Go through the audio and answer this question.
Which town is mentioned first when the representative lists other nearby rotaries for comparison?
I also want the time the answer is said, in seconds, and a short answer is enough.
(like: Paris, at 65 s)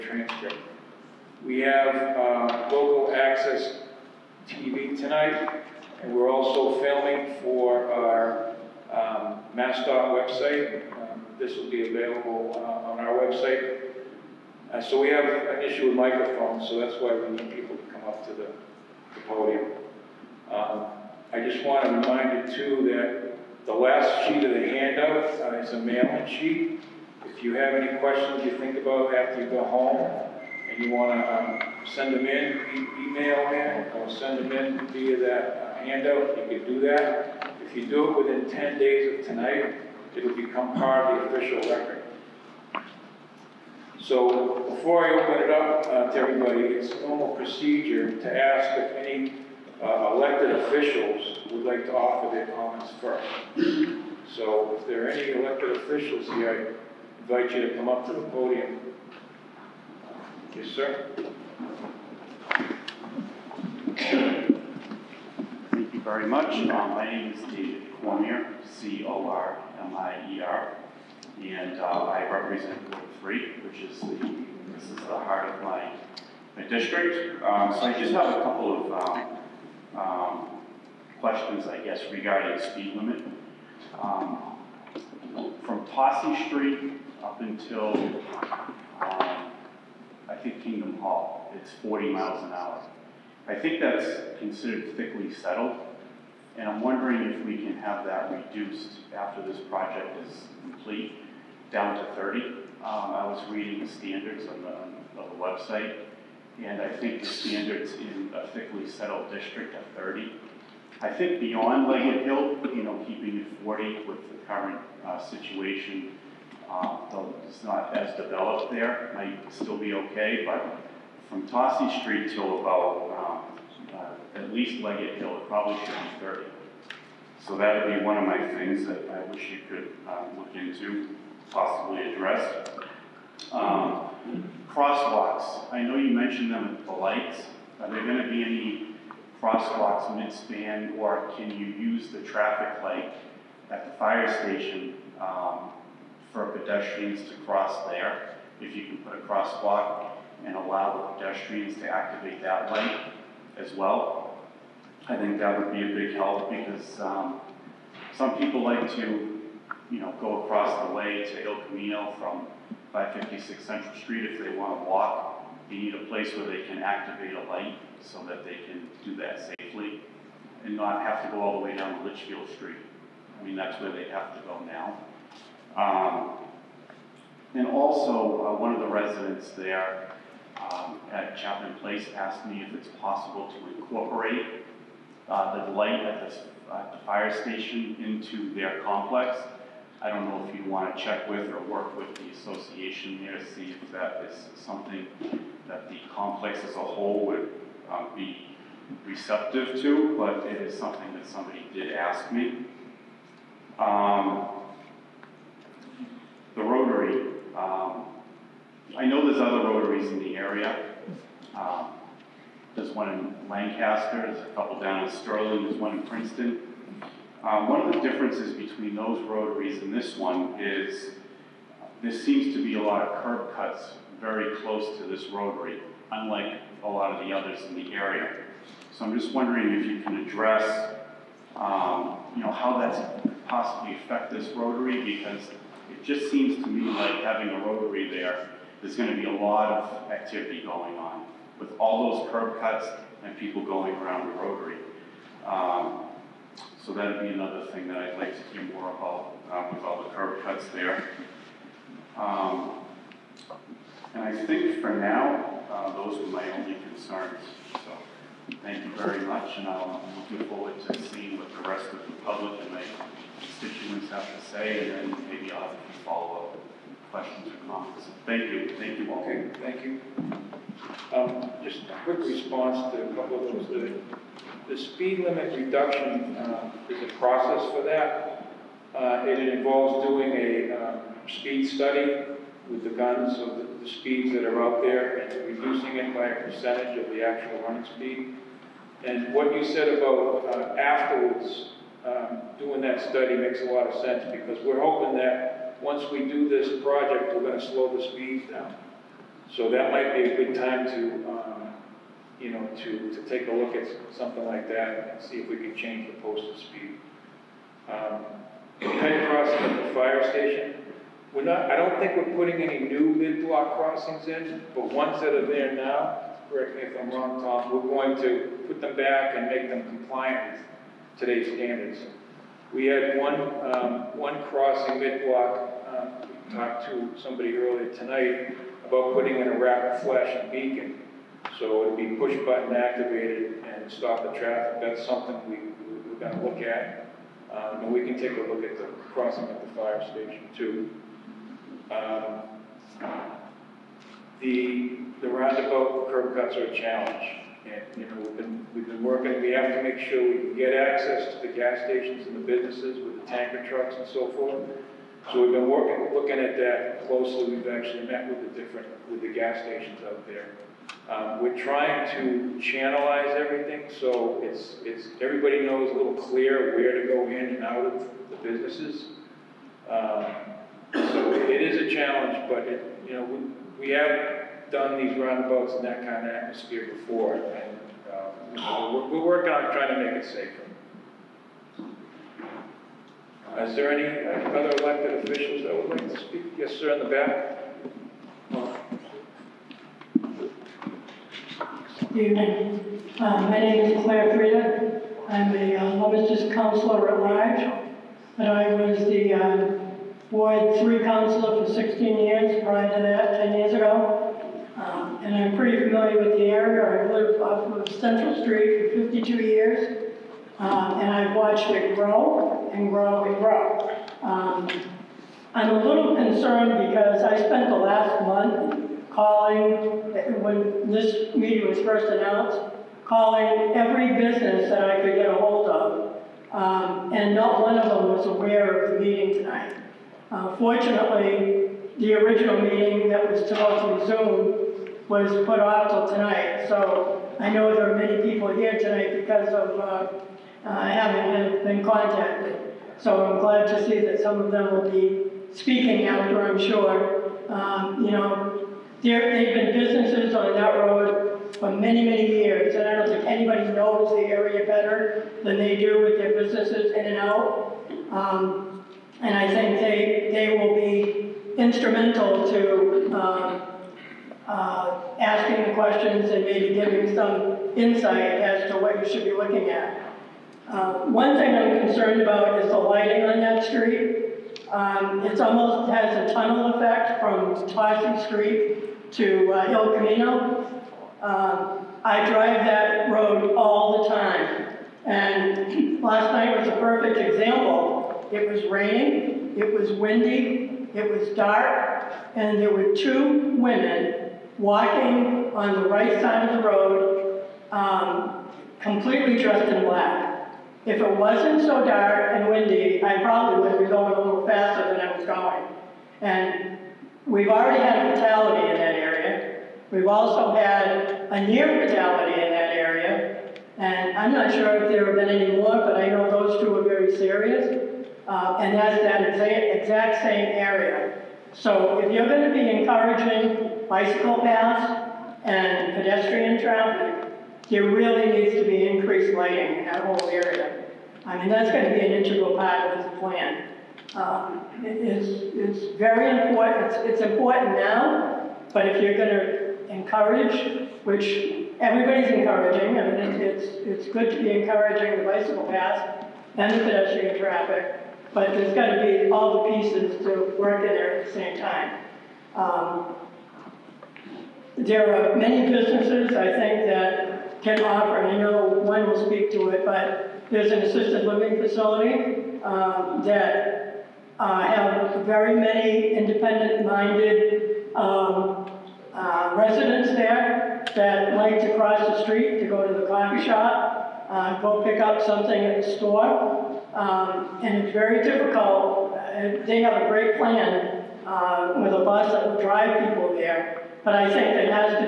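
Lancaster, at 213 s.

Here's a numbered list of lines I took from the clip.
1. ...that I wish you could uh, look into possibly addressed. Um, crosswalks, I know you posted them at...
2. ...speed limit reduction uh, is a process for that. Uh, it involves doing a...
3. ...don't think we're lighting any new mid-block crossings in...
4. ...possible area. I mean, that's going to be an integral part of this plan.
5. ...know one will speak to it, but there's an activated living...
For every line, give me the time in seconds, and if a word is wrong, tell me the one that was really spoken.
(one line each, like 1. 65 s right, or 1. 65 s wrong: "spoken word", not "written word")
1. 128 s wrong: "mentioned", not "posted"
2. 274 s right
3. 311 s wrong: "putting", not "lighting"
4. 530 s wrong: "whole", not "possible"
5. 558 s wrong: "assisted", not "activated".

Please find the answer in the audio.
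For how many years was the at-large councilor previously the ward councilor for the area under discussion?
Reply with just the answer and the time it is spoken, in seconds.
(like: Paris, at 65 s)
16, at 401 s.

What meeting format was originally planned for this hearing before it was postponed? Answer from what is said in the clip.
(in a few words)
Zoom.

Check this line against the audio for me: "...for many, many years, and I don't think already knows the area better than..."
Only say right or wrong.
wrong.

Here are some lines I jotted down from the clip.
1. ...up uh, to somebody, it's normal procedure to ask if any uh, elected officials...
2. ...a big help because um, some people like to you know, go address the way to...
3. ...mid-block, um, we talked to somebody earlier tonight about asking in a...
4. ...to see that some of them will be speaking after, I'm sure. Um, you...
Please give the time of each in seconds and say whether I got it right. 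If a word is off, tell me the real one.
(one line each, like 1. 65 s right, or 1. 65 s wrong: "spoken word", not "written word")
1. 45 s wrong: "everybody", not "somebody"
2. 155 s wrong: "across", not "address"
3. 324 s wrong: "putting", not "asking"
4. 443 s right.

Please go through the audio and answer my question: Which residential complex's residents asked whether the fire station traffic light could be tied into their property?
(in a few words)
Chapman Place.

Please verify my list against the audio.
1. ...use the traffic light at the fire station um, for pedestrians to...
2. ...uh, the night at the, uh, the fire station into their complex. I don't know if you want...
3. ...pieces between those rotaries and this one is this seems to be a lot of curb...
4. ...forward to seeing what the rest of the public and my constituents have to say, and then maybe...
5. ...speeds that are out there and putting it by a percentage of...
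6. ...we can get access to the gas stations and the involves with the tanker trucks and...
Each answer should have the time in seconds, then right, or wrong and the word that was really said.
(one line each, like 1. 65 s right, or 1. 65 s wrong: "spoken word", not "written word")
1. 141 s right
2. 185 s wrong: "light", not "night"
3. 218 s wrong: "differences", not "pieces"
4. 260 s right
5. 283 s wrong: "reducing", not "putting"
6. 350 s wrong: "businesses", not "involves".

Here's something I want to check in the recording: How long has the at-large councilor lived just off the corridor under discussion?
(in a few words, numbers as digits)
52 years.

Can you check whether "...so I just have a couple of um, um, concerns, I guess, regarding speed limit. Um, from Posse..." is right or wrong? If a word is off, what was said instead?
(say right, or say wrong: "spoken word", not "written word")
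wrong: "questions", not "concerns".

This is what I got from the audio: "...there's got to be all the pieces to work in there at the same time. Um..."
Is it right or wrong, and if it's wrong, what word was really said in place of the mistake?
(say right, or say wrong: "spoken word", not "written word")
right.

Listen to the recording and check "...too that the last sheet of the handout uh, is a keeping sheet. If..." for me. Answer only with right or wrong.
wrong.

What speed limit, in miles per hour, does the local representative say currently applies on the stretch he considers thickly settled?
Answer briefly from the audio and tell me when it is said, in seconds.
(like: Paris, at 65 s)
40, at 91 s.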